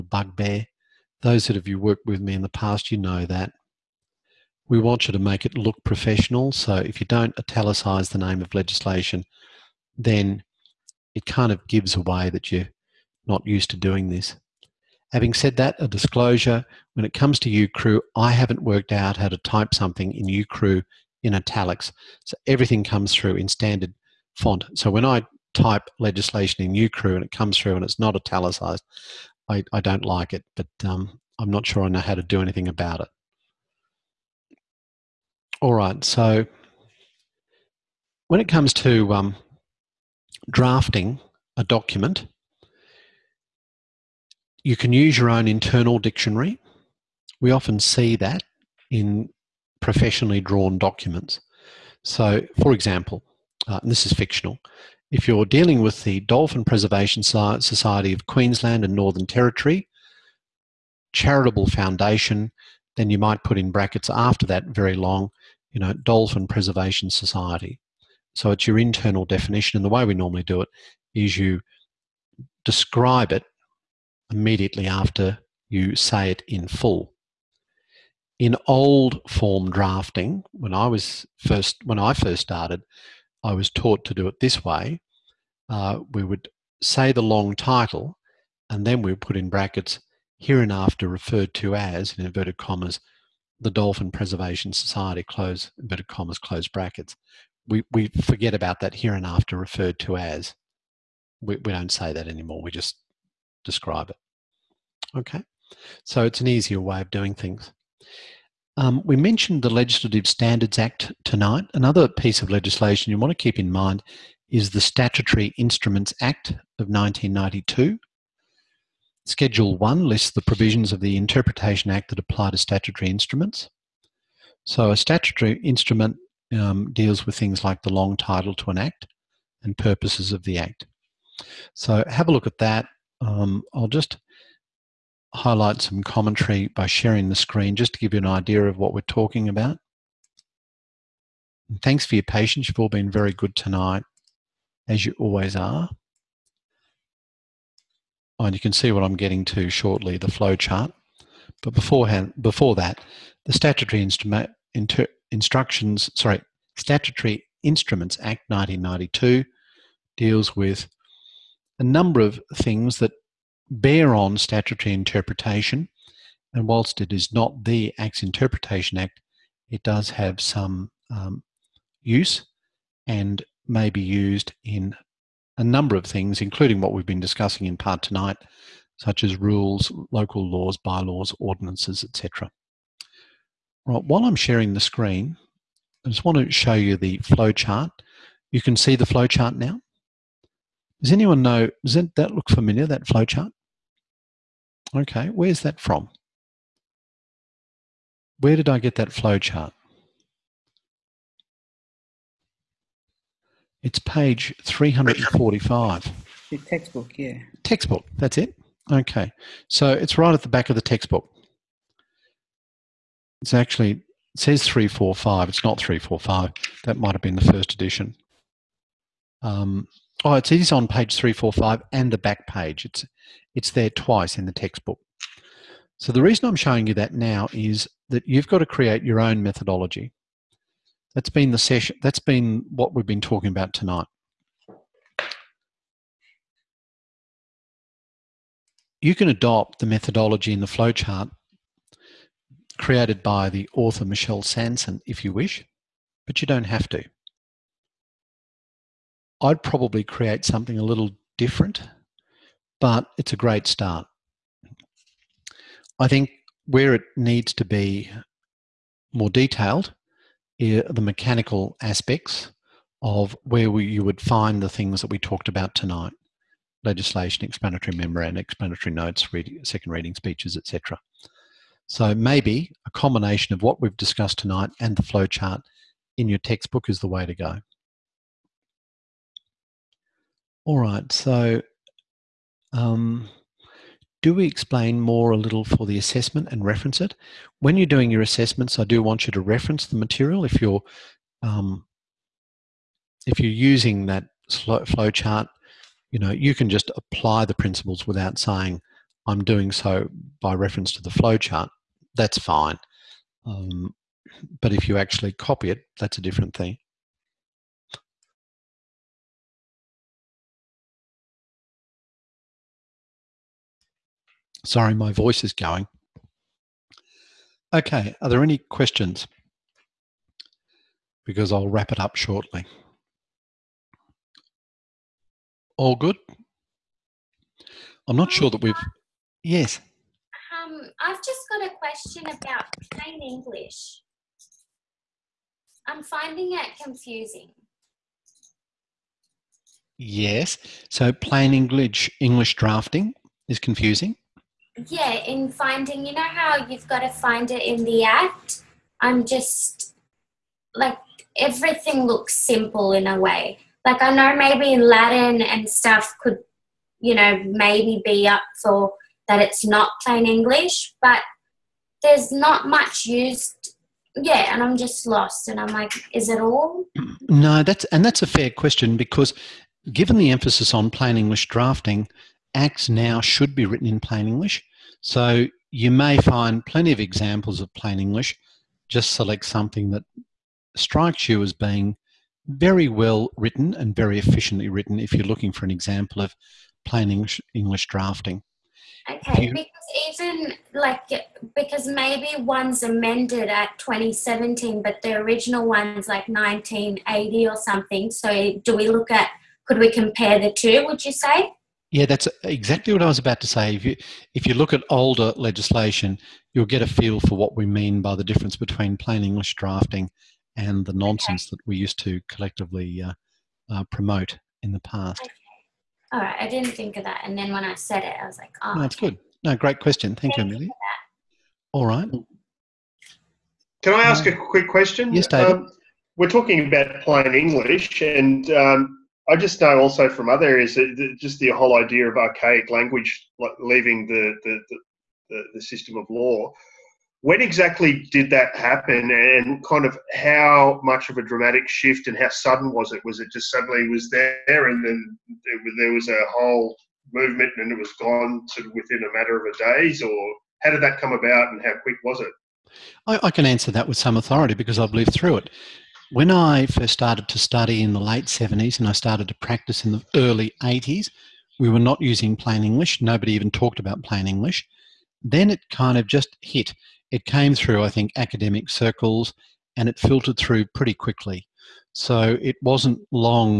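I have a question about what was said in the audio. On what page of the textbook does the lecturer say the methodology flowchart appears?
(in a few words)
345.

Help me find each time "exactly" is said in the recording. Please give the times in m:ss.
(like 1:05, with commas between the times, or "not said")
6:42, 7:17.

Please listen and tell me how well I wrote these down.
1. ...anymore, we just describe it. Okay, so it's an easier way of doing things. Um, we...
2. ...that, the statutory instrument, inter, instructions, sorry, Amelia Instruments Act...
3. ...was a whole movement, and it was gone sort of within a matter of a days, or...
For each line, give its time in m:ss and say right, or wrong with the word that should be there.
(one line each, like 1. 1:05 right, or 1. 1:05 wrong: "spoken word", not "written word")
1. 1:42 right
2. 2:32 wrong: "Statutory", not "Amelia"
3. 7:25 right.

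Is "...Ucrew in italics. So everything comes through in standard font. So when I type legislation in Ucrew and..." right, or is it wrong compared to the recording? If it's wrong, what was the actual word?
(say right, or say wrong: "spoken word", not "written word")
right.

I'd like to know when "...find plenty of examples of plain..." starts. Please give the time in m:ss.
6:16.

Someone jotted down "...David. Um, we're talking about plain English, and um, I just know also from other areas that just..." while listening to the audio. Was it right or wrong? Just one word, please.
right.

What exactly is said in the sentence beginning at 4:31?
So maybe a combination of what we've discussed tonight and the flowchart in your textbook is the way to go.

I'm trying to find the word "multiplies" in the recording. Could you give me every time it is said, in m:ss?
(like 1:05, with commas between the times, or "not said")
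not said.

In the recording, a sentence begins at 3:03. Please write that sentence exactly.
Right, while I'm sharing the screen, I just want to show you the flowchart.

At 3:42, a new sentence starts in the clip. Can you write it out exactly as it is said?
It's, it's there twice in the textbook.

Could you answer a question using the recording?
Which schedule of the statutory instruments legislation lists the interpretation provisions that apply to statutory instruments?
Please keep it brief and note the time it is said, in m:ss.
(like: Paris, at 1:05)
Schedule 1, at 1:59.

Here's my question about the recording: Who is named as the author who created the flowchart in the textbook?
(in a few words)
Michelle Sanson.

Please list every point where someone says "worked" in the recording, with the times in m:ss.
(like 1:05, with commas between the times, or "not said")
0:01, 0:18.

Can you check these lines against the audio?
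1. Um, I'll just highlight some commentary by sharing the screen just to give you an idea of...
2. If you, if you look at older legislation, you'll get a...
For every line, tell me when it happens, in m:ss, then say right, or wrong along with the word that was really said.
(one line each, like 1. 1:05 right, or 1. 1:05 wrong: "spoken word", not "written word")
1. 2:13 right
2. 6:43 right.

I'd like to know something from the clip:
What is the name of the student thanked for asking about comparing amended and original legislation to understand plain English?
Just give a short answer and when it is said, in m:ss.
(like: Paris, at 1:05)
Amelia, at 7:00.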